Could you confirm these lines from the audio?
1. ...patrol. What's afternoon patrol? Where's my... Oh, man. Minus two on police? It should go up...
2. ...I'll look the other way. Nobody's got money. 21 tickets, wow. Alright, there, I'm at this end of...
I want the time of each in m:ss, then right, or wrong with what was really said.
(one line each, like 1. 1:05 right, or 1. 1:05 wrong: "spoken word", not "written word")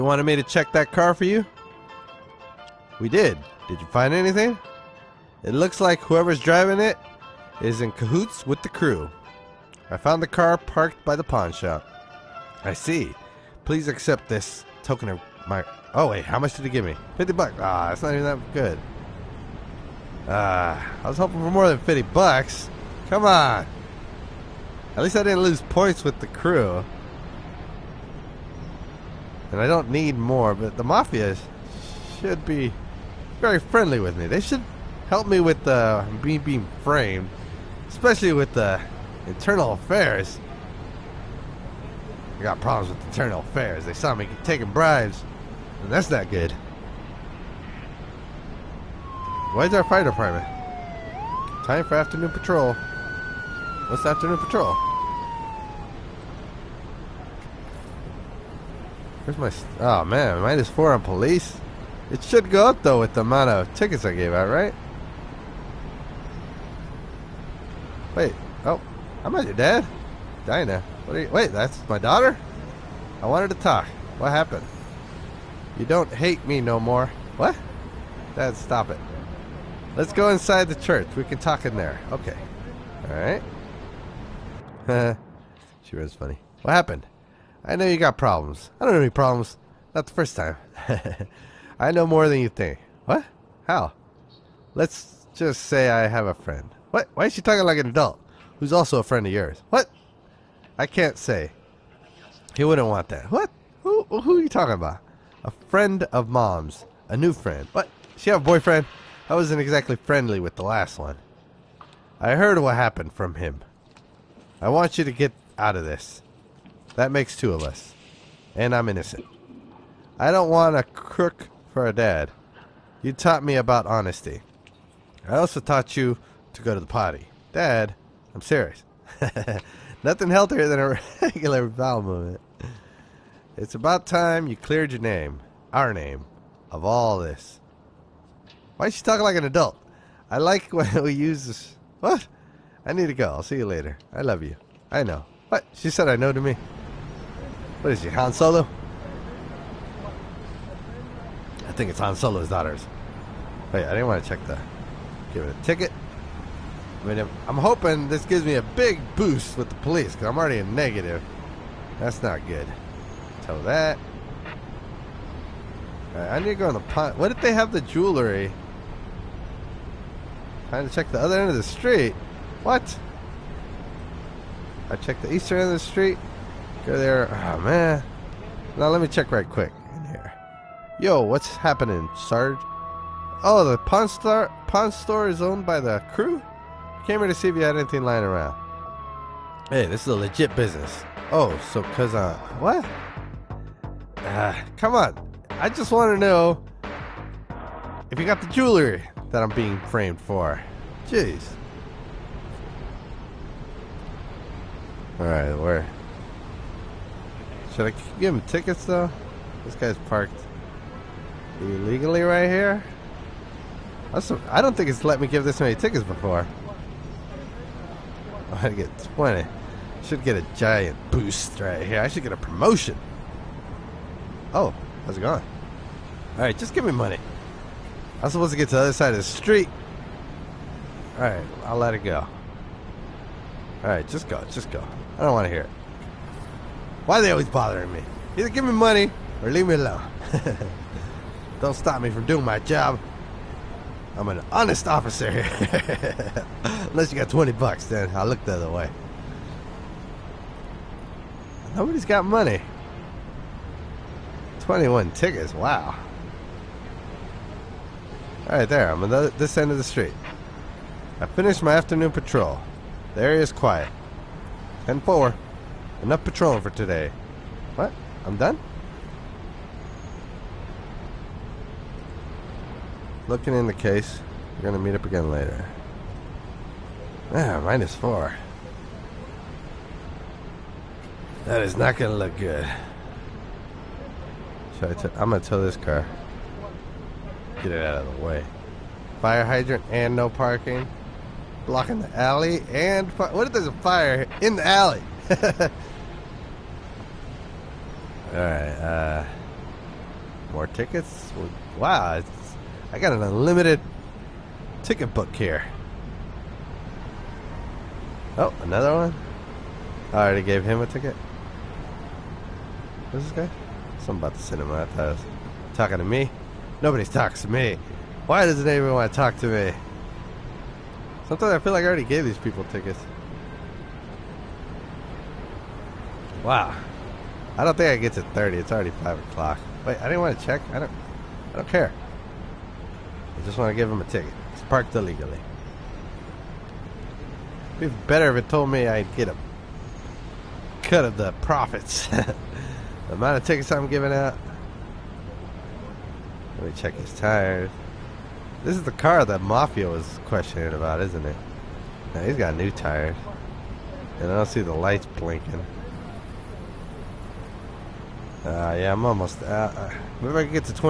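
1. 0:52 wrong: "four", not "two"
2. 4:08 right.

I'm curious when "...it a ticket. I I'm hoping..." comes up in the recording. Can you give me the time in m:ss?
2:35.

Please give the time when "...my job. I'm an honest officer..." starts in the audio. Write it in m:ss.
4:02.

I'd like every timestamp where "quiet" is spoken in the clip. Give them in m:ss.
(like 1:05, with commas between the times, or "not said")
4:23.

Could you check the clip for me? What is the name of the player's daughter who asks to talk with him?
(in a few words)
Dinah.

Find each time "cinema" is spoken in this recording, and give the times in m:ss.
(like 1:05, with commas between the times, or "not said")
5:14.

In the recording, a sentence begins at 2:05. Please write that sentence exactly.
I also taught you to go to the potty.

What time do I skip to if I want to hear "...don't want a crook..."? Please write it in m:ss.
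2:00.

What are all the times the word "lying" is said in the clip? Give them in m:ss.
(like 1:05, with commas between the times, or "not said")
3:08.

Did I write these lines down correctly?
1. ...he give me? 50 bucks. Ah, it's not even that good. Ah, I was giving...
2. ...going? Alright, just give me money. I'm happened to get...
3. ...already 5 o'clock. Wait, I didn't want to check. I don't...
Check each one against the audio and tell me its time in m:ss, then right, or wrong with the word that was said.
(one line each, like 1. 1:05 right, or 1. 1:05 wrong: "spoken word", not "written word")
1. 0:16 wrong: "hoping", not "giving"
2. 3:45 wrong: "supposed", not "happened"
3. 5:28 right.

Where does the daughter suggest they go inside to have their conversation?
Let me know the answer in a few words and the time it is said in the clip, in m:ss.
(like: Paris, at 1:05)
The church, at 1:20.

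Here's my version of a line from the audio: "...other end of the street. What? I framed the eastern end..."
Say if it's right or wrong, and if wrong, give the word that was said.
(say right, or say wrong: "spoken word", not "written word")
wrong: "checked", not "framed".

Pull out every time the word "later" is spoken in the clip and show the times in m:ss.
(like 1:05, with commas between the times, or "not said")
2:23, 4:35.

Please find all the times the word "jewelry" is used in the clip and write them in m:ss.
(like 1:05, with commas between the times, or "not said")
2:47, 3:18.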